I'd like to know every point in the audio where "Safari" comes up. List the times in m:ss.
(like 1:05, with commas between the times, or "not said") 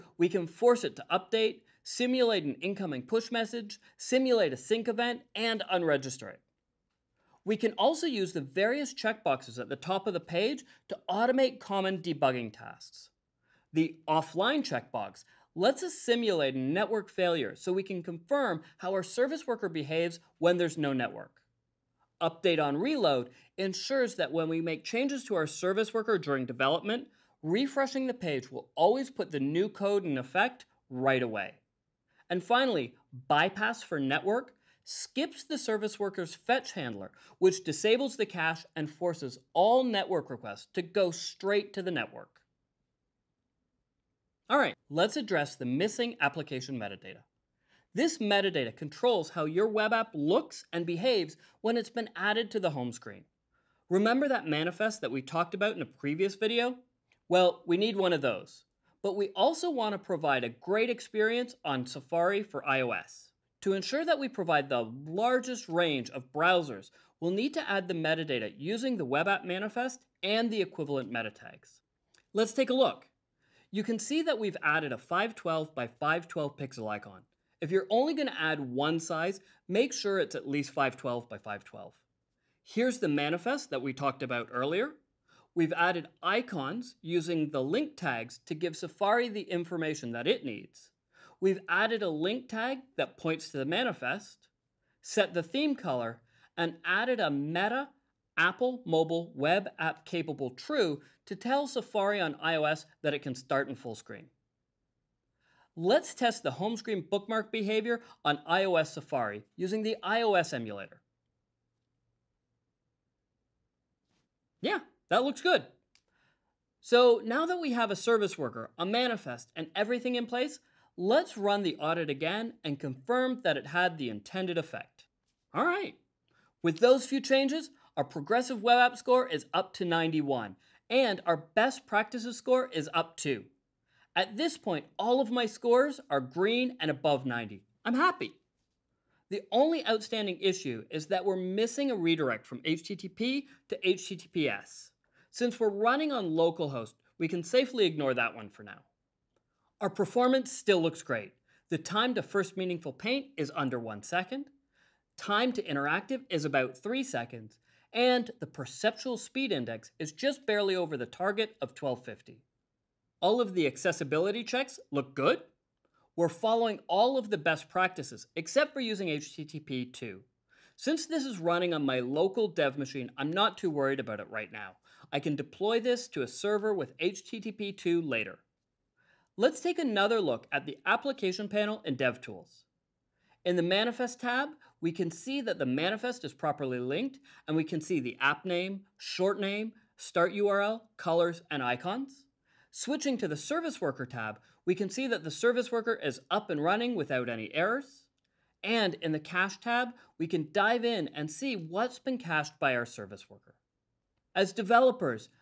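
1:01, 1:28, 1:41, 1:48.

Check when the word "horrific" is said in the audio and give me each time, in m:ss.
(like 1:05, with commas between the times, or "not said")
not said.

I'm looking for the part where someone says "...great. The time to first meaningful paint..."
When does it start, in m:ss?
2:31.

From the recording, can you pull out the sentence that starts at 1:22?
Here's the manifest that we talked about earlier.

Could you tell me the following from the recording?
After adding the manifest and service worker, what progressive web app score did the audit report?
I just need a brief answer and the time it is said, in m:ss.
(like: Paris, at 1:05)
91, at 2:09.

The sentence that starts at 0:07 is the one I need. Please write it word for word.
We can also use the various checkboxes at the top of the page to automate common debugging tasks.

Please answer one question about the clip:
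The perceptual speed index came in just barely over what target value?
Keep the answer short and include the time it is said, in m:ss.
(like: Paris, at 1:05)
1250, at 2:41.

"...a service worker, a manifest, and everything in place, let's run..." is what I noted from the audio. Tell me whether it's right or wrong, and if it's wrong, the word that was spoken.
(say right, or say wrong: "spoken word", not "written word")
right.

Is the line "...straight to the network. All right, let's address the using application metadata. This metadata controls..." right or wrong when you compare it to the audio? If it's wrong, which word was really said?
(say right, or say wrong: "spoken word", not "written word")
wrong: "missing", not "using".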